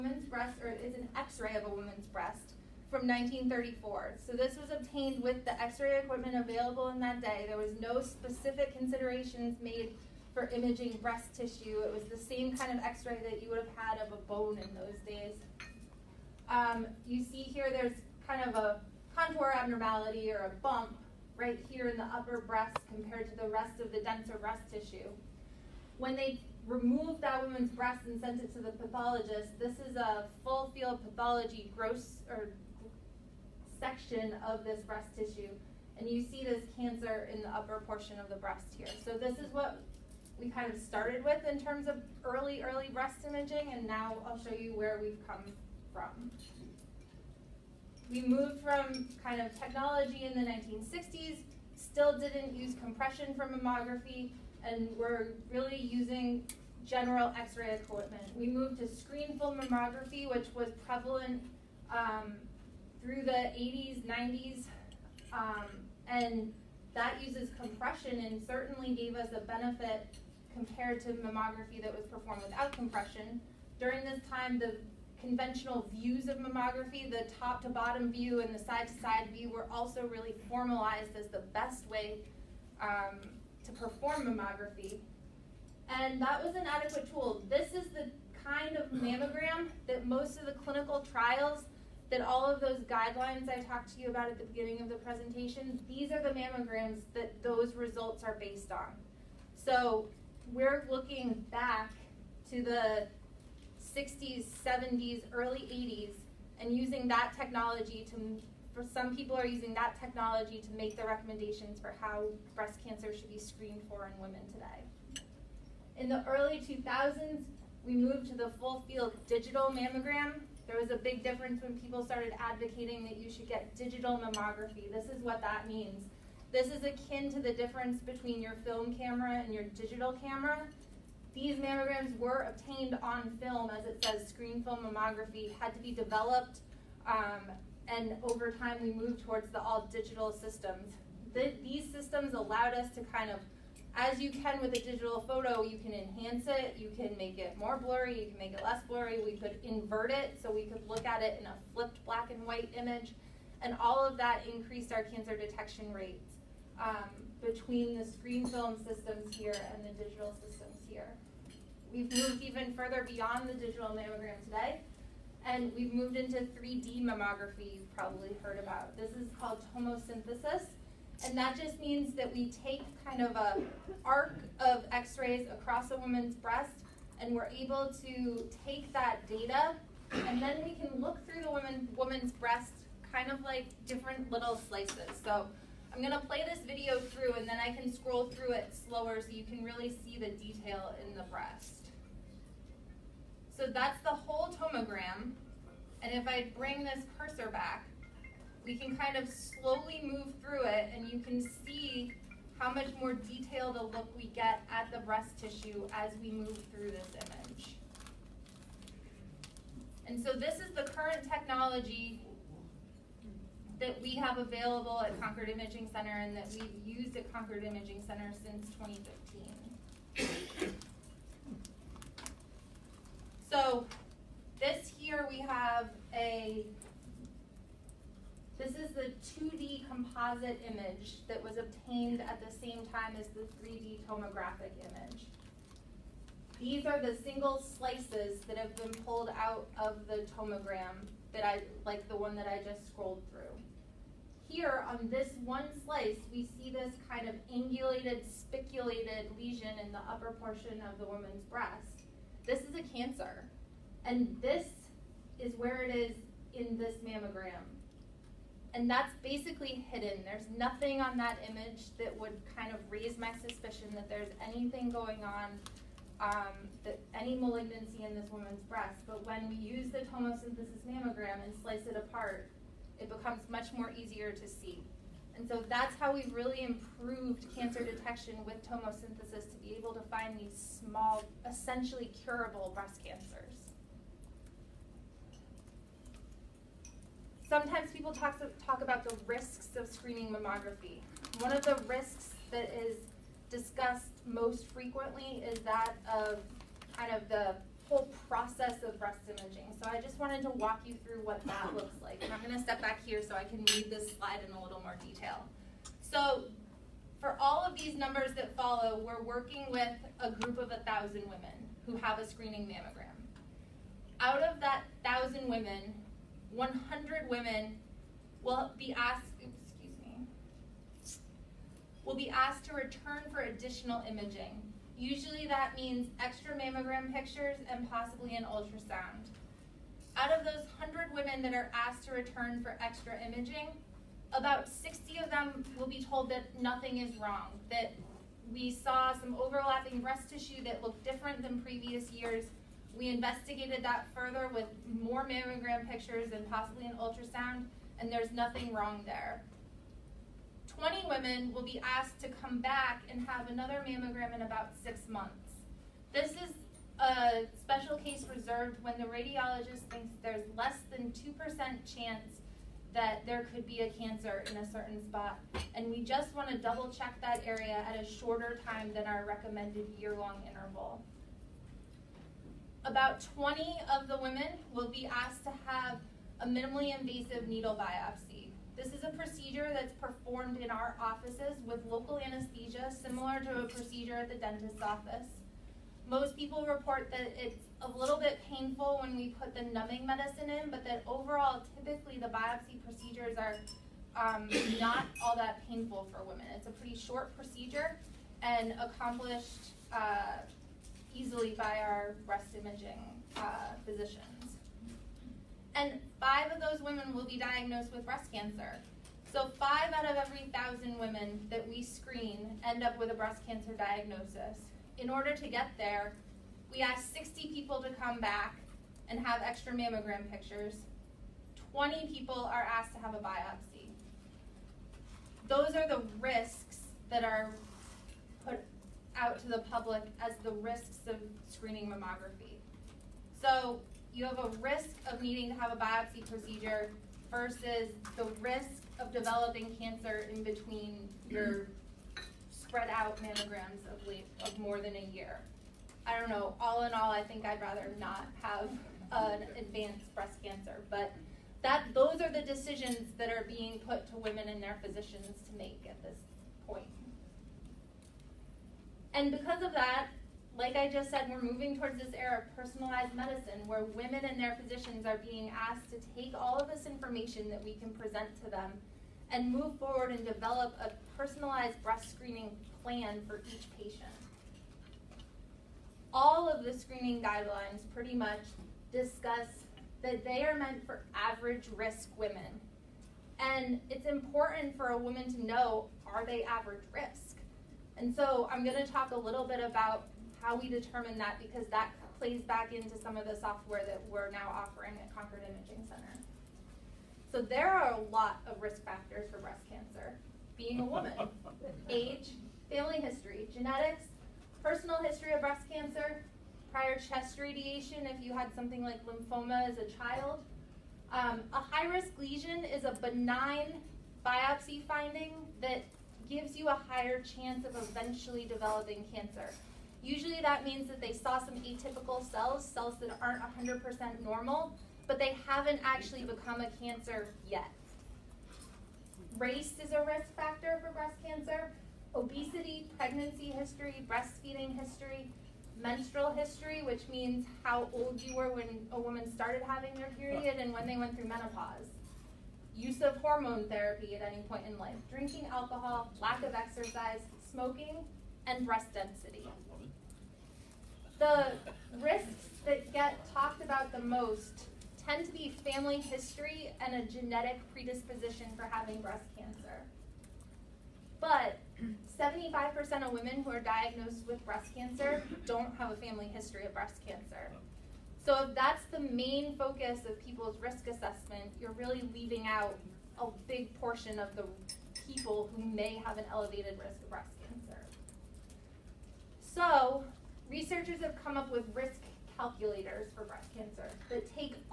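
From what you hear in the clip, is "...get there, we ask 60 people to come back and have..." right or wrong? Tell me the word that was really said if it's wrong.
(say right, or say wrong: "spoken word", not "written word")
right.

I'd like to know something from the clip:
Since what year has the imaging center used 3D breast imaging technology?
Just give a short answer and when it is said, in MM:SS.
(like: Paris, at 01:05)
2015, at 03:38.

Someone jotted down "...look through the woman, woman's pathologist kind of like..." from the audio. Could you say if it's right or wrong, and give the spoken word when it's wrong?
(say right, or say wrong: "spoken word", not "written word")
wrong: "breast", not "pathologist".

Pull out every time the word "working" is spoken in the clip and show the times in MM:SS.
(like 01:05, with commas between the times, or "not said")
05:09.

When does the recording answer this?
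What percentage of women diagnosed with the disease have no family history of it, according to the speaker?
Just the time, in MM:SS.
09:22.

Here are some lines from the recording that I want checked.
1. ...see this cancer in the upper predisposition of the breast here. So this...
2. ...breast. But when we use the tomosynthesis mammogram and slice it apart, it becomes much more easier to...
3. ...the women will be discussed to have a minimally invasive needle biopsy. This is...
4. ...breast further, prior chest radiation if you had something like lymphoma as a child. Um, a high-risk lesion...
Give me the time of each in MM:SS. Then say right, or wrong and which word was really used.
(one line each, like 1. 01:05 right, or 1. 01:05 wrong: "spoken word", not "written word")
1. 00:36 wrong: "portion", not "predisposition"
2. 04:28 right
3. 06:14 wrong: "asked", not "discussed"
4. 08:25 wrong: "cancer", not "further".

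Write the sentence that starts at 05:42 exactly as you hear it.
We investigated that further with more mammogram pictures and possibly an ultrasound, and there's nothing wrong there.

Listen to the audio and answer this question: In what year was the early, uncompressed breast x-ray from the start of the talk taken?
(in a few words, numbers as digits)
1934.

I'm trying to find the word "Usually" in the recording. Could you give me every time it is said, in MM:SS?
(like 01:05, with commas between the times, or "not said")
05:24, 08:40.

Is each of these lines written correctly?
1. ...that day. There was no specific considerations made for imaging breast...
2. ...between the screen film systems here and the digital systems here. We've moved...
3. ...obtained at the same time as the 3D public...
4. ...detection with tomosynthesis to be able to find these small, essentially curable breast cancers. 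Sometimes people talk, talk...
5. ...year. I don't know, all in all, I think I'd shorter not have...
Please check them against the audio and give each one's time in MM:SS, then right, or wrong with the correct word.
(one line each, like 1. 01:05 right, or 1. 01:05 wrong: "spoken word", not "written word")
1. 00:06 right
2. 02:37 right
3. 03:51 wrong: "tomographic", not "public"
4. 04:37 right
5. 07:25 wrong: "rather", not "shorter".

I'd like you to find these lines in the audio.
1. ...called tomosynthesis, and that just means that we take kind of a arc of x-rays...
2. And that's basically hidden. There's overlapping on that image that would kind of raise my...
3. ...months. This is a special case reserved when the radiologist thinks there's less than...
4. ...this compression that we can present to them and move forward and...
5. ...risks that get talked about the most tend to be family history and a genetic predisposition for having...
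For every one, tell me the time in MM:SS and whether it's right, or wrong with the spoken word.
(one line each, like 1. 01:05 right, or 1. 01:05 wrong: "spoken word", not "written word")
1. 02:49 right
2. 04:18 wrong: "nothing", not "overlapping"
3. 05:55 right
4. 07:46 wrong: "information", not "compression"
5. 09:12 right.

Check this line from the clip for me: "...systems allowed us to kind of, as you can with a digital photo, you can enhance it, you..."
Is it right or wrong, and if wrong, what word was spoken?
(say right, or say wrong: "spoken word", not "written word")
right.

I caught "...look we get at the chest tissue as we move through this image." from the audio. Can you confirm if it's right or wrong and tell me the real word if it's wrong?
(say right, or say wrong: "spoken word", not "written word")
wrong: "breast", not "chest".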